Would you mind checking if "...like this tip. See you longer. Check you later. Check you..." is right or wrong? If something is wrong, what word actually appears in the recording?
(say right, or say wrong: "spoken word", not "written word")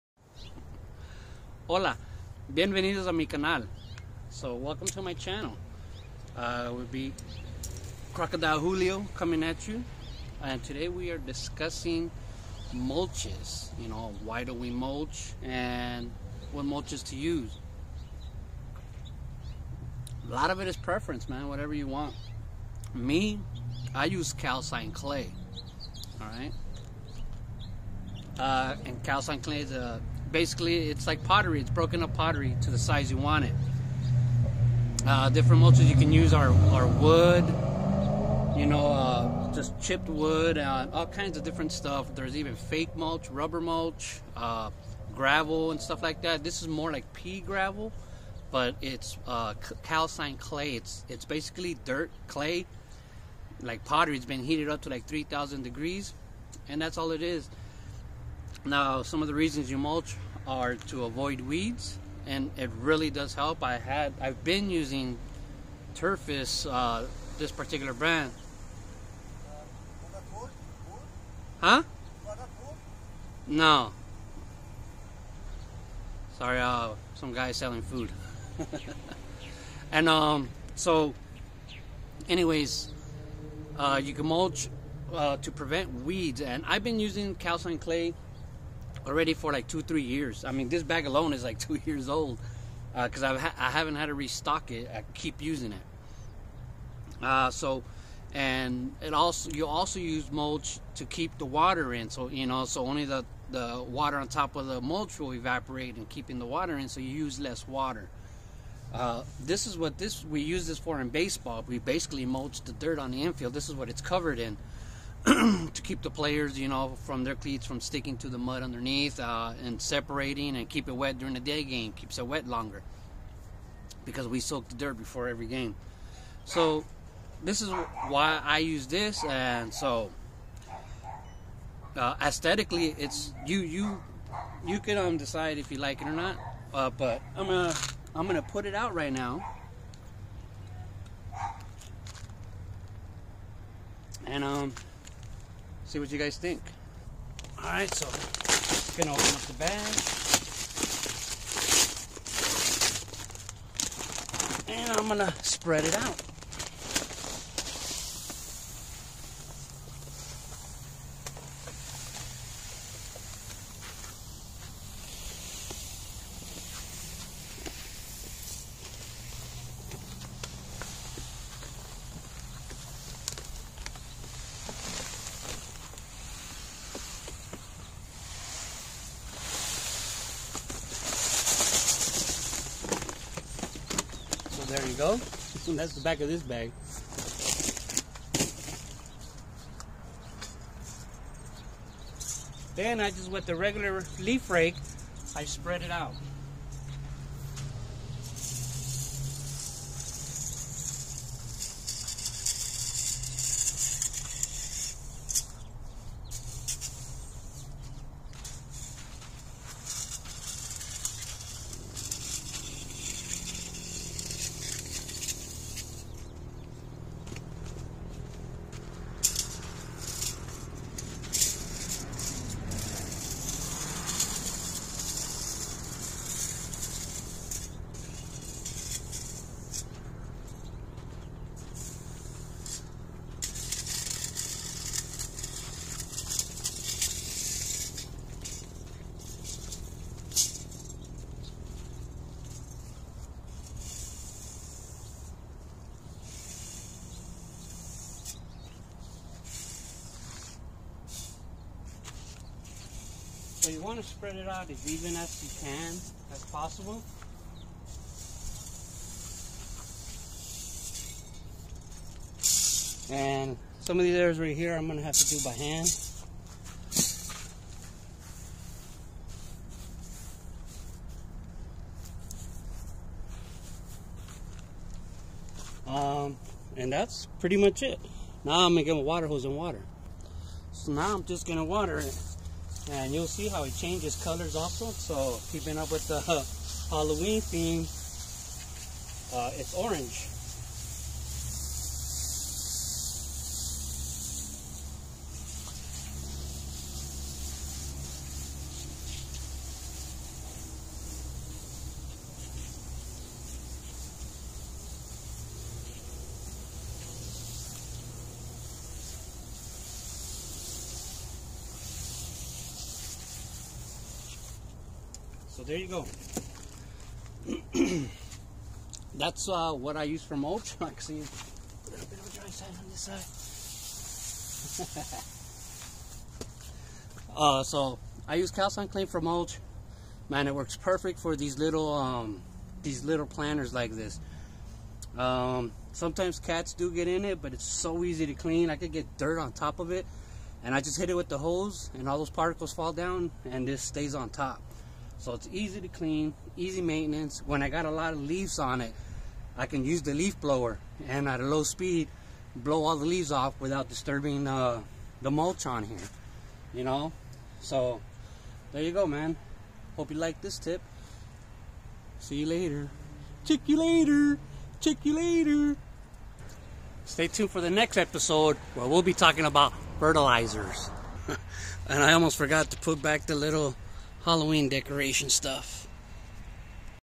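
wrong: "later", not "longer".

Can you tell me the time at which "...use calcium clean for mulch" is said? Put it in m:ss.
5:28.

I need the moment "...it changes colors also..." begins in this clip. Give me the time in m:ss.
4:43.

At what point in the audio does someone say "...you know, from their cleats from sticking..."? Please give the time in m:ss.
1:56.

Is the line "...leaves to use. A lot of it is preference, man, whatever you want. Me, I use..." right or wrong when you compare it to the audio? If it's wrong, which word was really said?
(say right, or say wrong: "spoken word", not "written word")
wrong: "mulches", not "leaves".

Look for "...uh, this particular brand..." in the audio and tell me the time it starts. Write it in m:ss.
1:06.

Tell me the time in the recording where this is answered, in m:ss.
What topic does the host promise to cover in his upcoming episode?
6:09.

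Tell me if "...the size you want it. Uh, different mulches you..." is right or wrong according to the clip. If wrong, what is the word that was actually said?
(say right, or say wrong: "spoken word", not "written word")
right.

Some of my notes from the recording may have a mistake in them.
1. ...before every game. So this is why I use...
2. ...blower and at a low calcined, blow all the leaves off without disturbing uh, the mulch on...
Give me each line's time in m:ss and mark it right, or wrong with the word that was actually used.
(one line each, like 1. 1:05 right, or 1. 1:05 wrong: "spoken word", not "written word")
1. 2:04 right
2. 5:50 wrong: "speed", not "calcined".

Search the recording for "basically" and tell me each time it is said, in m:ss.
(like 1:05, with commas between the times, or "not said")
0:30, 0:51, 1:51.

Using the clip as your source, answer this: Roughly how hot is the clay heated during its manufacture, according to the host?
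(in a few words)
3,000 degrees.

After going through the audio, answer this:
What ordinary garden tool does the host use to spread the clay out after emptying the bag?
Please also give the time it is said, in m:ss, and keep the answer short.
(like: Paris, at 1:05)
leaf rake, at 3:14.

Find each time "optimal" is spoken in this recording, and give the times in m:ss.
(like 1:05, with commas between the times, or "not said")
not said.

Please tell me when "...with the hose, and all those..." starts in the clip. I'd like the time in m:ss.
5:41.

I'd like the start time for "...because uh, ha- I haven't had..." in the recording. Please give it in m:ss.
1:32.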